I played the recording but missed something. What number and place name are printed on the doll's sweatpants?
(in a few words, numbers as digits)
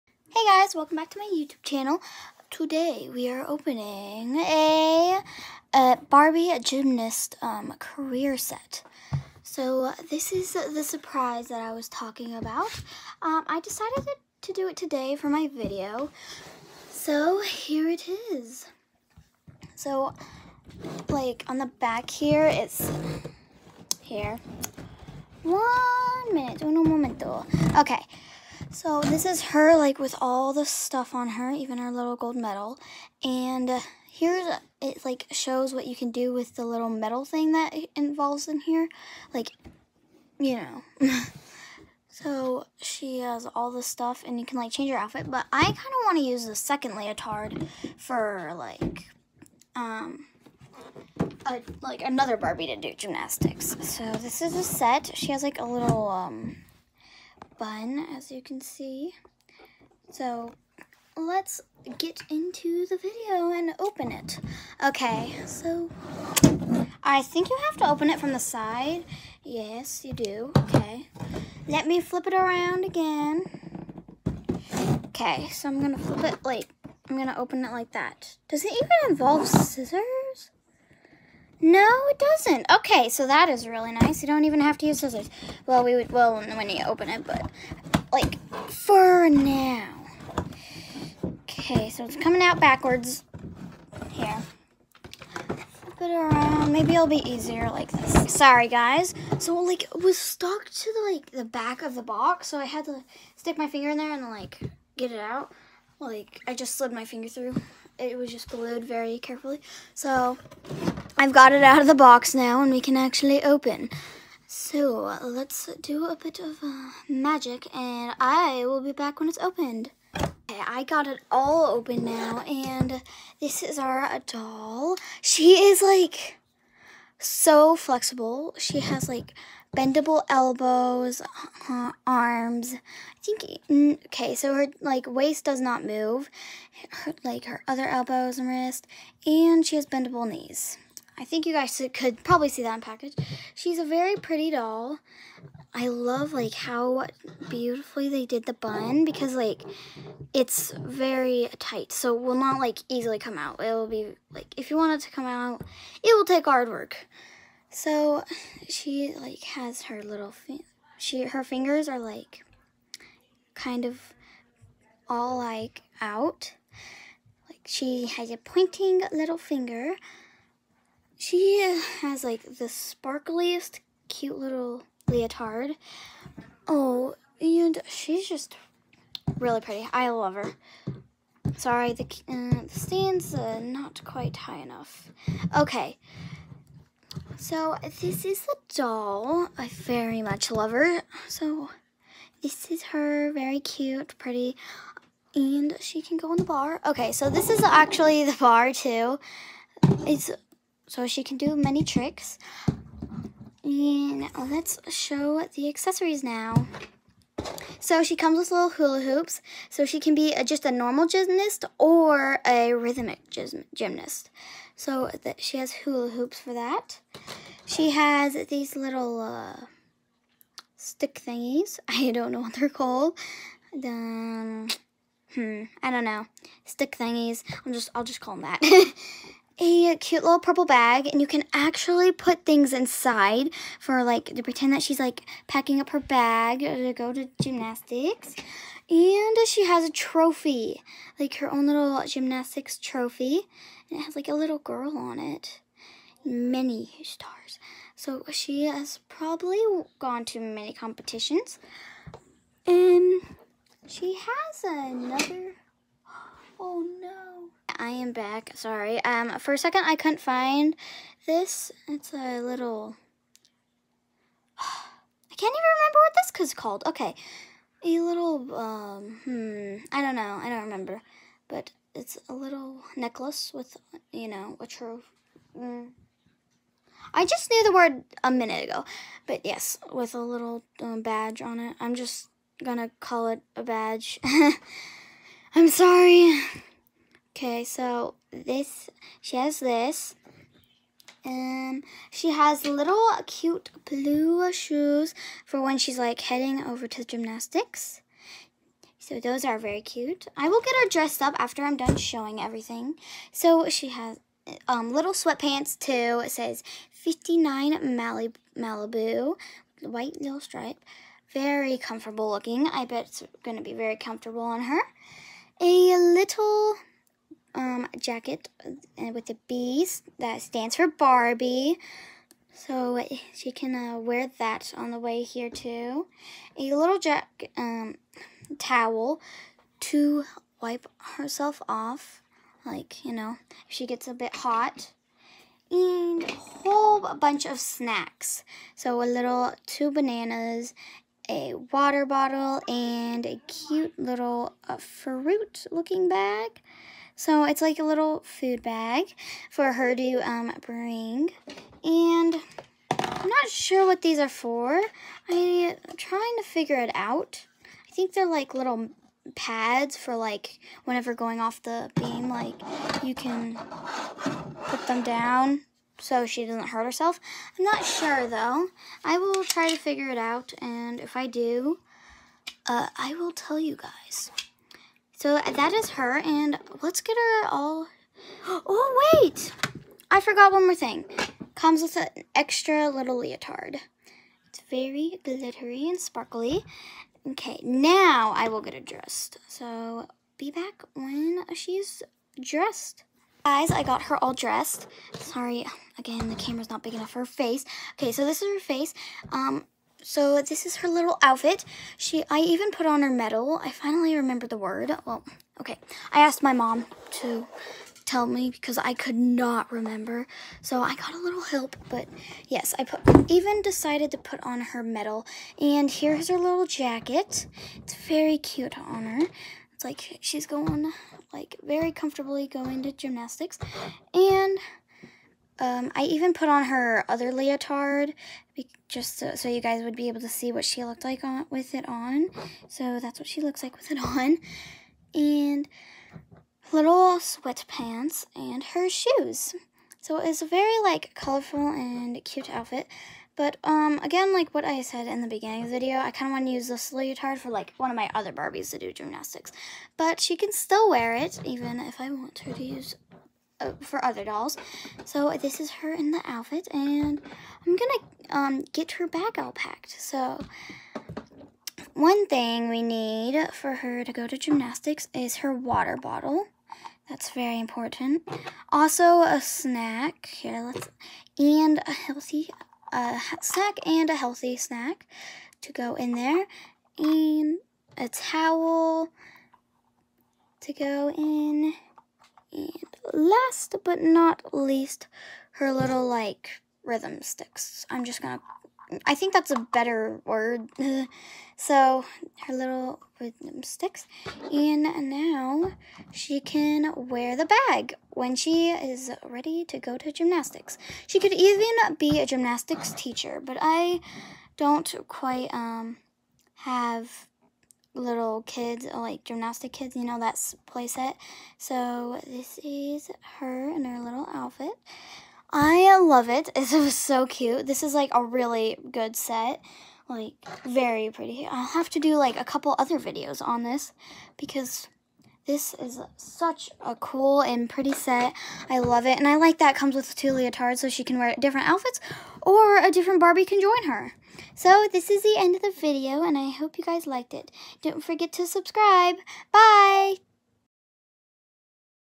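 59 Malibu.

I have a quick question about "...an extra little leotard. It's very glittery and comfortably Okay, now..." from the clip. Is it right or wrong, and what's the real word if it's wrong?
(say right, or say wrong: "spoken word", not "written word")
wrong: "sparkly", not "comfortably".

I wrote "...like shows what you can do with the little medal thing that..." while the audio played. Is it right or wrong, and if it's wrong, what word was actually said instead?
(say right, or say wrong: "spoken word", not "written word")
wrong: "metal", not "medal".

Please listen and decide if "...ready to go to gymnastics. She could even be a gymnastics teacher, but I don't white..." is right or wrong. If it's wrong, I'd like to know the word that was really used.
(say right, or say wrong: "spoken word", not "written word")
wrong: "quite", not "white".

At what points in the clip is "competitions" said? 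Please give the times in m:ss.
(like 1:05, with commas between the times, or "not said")
4:10.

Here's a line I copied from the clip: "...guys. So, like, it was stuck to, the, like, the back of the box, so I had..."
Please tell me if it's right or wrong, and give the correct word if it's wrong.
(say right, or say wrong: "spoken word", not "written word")
right.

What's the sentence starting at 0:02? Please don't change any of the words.
Today we are opening a, a Barbie Gymnast um, career set.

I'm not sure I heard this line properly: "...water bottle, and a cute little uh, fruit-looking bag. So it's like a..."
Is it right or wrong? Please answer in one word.
right.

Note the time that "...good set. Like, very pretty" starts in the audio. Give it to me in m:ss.
8:38.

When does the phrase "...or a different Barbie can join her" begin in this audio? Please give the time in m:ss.
8:52.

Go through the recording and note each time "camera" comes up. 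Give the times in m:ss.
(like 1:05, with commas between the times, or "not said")
6:36.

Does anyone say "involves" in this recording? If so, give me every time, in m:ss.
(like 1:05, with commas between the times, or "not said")
0:37, 1:19.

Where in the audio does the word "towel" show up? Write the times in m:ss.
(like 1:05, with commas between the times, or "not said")
5:28, 7:58.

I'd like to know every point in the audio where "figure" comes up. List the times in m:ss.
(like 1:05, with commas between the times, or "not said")
5:56, 6:09.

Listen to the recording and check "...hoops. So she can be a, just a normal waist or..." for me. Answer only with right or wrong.
wrong.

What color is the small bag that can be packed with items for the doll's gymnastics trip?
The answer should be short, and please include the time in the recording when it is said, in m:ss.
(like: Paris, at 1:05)
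Purple, at 3:50.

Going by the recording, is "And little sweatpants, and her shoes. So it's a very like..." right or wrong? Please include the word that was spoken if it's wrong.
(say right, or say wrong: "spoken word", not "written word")
right.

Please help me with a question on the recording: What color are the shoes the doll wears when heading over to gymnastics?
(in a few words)
Blue.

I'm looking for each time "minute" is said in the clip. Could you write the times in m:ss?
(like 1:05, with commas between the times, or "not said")
0:26, 4:38.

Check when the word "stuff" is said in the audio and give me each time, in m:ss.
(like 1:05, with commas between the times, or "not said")
0:30, 0:43.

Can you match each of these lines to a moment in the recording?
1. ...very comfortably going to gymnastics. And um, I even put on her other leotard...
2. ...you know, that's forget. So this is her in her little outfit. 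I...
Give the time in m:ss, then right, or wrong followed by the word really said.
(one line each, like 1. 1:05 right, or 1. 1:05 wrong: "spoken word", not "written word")
1. 7:01 right
2. 8:29 wrong: "playset", not "forget".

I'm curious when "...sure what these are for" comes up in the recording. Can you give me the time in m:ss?
5:53.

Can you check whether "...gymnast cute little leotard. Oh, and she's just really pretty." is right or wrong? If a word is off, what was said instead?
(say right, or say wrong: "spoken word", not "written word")
wrong: "sparkliest", not "gymnast".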